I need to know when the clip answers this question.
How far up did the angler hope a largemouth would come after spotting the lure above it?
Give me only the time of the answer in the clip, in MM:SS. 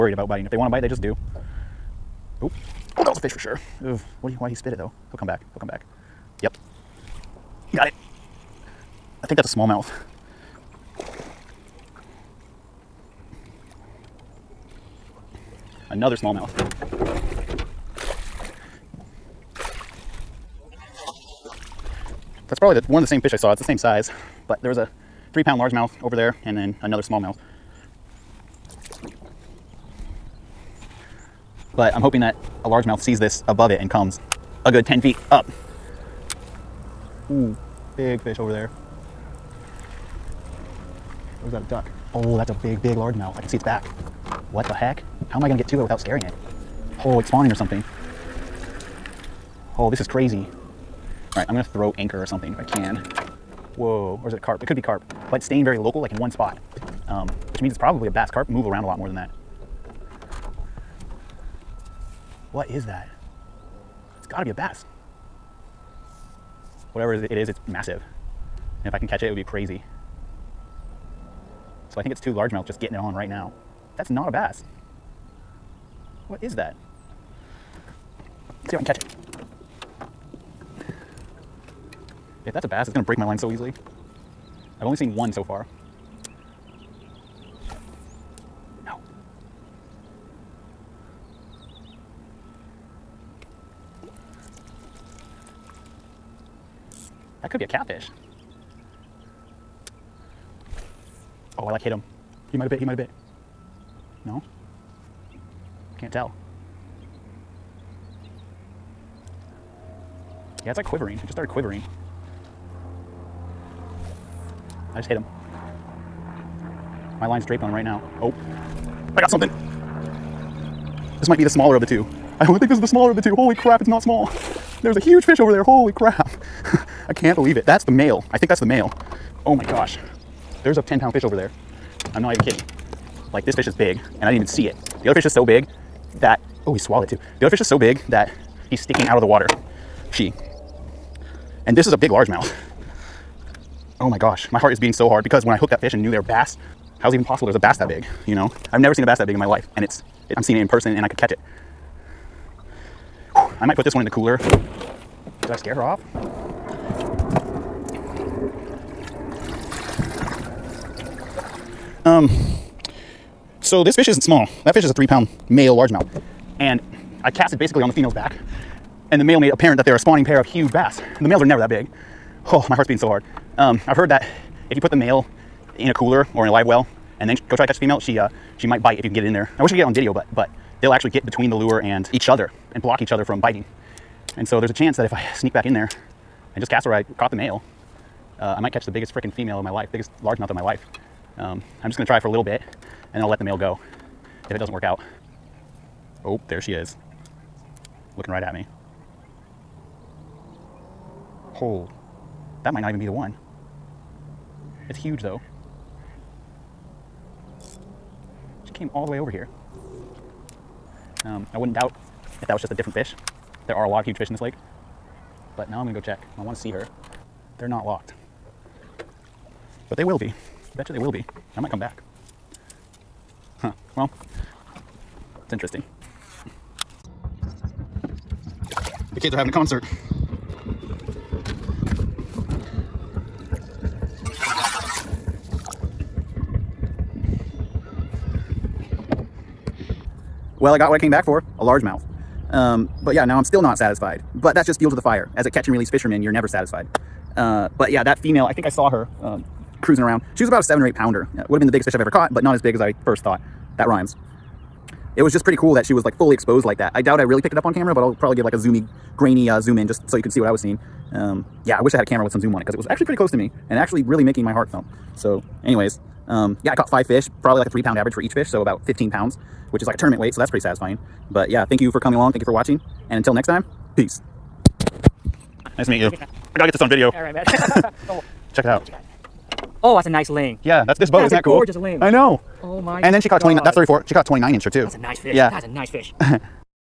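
00:34.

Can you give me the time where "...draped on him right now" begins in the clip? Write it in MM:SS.
01:57.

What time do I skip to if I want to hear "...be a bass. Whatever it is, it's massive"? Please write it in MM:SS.
01:04.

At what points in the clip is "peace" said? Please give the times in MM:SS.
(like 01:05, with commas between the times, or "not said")
04:33.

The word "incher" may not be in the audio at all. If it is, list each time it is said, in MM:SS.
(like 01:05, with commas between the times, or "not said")
04:44.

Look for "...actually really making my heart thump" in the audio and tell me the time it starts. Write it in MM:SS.
04:23.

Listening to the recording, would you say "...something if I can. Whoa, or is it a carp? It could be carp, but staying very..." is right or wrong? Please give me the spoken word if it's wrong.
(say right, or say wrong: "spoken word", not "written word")
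right.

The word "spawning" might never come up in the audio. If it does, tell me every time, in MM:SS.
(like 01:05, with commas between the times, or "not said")
00:47, 02:49.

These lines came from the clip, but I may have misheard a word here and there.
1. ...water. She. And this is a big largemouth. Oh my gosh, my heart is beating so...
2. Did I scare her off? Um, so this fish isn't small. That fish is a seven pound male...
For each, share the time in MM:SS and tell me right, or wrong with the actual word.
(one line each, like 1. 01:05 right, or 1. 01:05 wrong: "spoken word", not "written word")
1. 02:19 right
2. 02:35 wrong: "three", not "seven".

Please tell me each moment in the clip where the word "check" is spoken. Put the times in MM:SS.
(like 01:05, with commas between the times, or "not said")
03:35, 04:38.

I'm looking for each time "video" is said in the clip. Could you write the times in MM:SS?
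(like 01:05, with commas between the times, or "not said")
02:59, 04:36.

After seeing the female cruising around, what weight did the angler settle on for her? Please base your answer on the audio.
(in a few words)
7 or 8 pounds.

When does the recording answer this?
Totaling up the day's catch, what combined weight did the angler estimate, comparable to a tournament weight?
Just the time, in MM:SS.
04:28.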